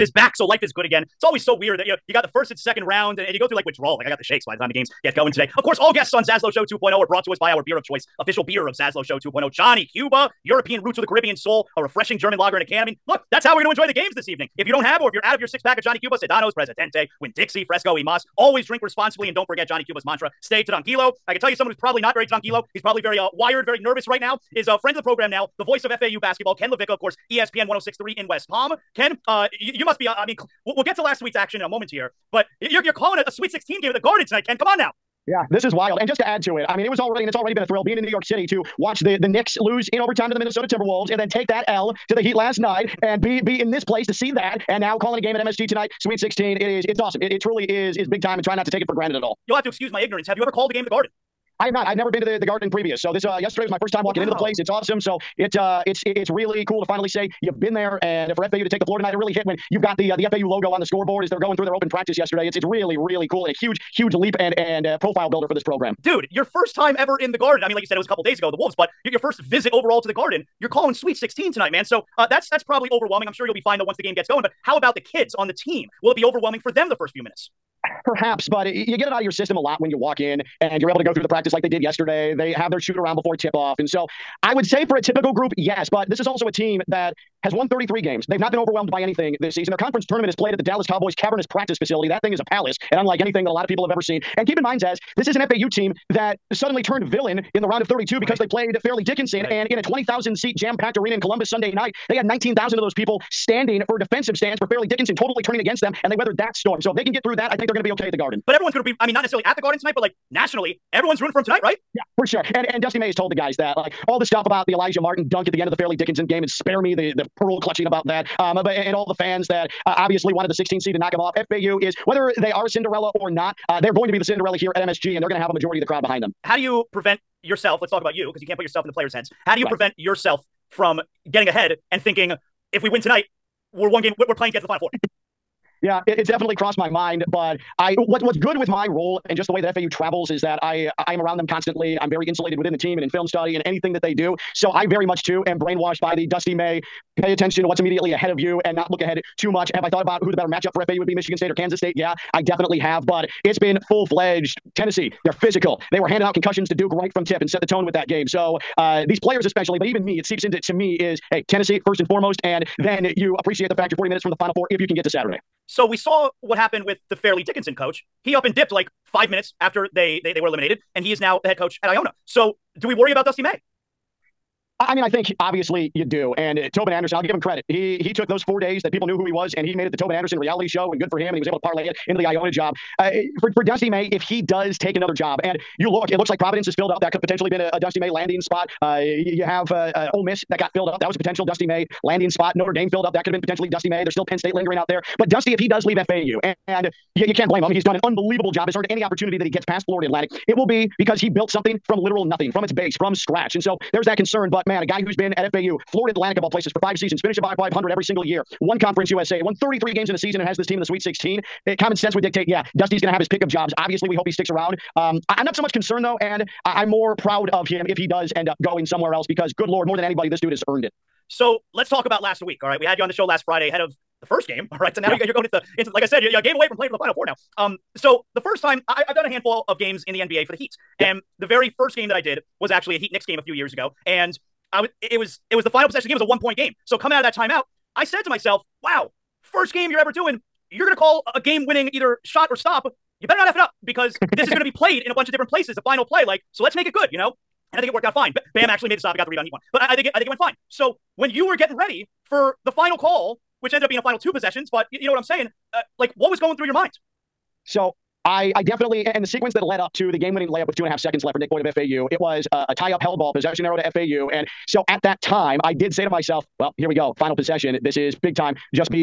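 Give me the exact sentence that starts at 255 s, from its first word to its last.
Uh, like, what was going through your mind?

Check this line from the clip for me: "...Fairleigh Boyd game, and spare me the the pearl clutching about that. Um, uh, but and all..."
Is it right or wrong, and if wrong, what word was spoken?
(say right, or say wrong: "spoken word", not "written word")
wrong: "Dickinson", not "Boyd".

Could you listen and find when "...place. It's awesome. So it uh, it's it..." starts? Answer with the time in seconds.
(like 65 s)
54 s.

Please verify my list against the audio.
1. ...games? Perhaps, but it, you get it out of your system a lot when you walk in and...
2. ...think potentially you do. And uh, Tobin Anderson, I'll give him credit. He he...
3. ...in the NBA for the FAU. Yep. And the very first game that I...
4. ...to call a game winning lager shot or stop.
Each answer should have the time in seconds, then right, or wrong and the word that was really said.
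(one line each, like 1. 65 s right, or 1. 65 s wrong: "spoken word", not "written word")
1. 77 s wrong: "minutes", not "games"
2. 175 s wrong: "obviously", not "potentially"
3. 230 s wrong: "Heat", not "FAU"
4. 240 s wrong: "either", not "lager".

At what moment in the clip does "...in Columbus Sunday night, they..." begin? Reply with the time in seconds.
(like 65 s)
101 s.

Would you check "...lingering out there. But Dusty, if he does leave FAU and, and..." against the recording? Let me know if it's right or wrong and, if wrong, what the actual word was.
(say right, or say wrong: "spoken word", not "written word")
right.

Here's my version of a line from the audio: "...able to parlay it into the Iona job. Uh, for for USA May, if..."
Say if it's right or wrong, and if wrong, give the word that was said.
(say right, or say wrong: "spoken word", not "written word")
wrong: "Dusty", not "USA".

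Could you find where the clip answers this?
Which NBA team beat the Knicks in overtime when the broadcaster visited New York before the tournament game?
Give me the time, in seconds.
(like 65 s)
40 s.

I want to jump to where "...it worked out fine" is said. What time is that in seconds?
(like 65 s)
247 s.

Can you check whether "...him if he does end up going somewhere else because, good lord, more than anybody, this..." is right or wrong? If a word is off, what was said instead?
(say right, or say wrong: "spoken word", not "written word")
right.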